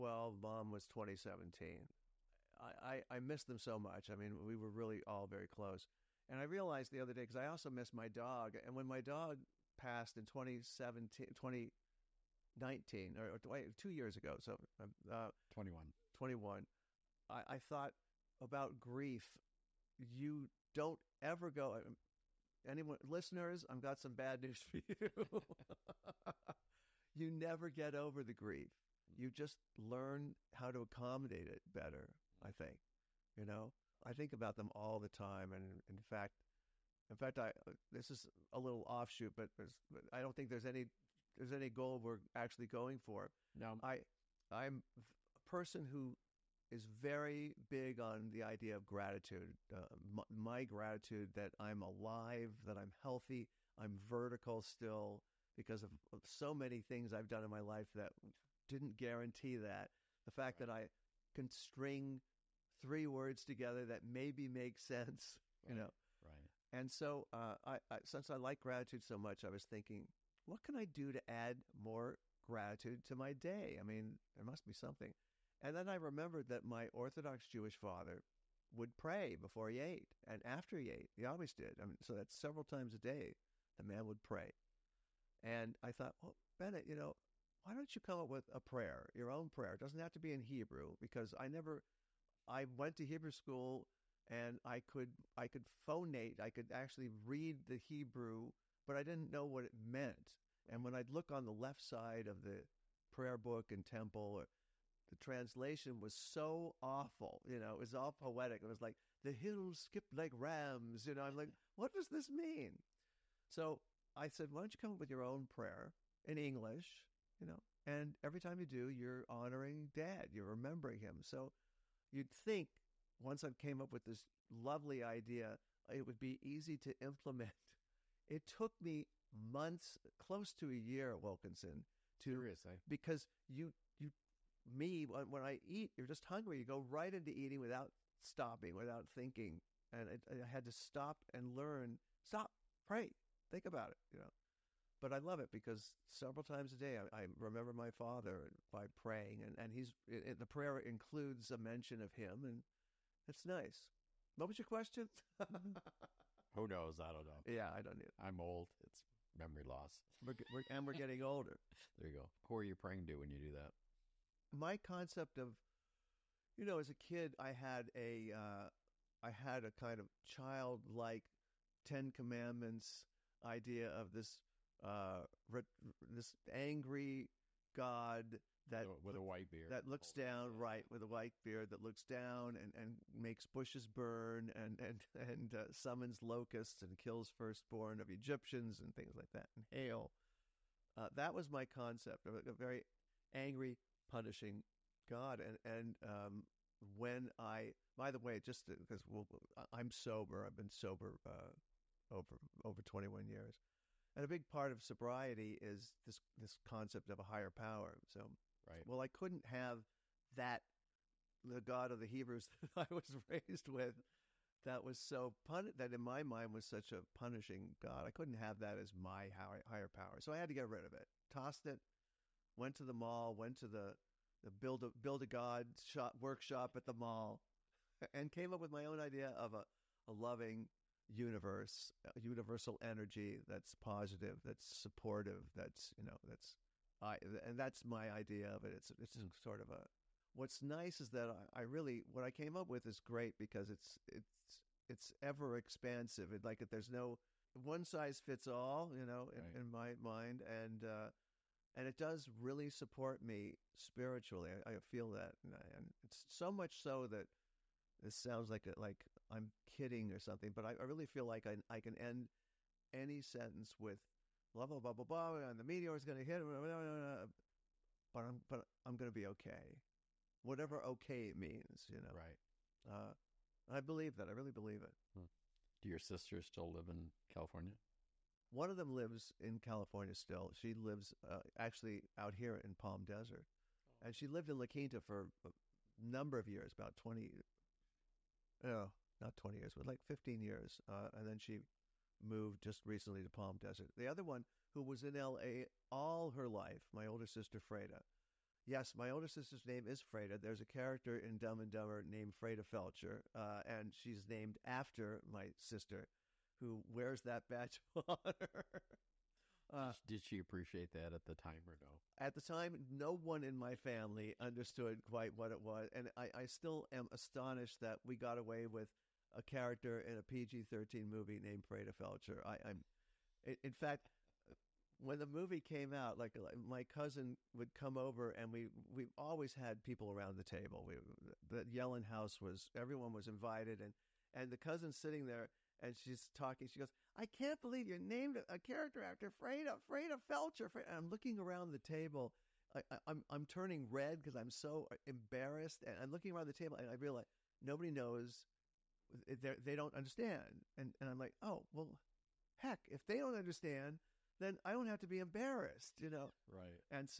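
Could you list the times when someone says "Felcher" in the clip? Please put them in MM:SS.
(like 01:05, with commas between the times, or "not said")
05:02, 05:21, 05:40.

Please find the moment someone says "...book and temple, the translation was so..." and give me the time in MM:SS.
01:43.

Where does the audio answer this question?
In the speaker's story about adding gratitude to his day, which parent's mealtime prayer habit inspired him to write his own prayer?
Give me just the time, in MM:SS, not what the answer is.
01:16.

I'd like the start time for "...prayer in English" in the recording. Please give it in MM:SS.
01:55.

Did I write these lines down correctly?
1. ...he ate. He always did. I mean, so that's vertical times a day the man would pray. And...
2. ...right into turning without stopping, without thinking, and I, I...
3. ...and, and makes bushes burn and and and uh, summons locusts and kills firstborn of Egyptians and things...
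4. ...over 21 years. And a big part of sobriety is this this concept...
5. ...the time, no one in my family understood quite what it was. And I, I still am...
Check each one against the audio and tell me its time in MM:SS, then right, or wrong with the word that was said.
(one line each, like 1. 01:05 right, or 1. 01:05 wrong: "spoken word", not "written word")
1. 01:20 wrong: "several", not "vertical"
2. 02:16 wrong: "eating", not "turning"
3. 03:02 right
4. 03:22 right
5. 05:12 right.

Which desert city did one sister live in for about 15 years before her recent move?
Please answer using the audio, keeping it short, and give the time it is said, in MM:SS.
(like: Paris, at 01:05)
La Quinta, at 04:44.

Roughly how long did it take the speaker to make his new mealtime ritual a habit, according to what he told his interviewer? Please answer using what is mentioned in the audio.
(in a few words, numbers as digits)
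close to a year.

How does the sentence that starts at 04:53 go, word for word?
The other one who was in LA all her life, my older sister Freda.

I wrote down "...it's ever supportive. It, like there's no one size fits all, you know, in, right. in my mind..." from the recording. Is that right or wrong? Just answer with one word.
wrong.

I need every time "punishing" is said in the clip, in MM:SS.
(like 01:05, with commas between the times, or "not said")
03:14, 03:37.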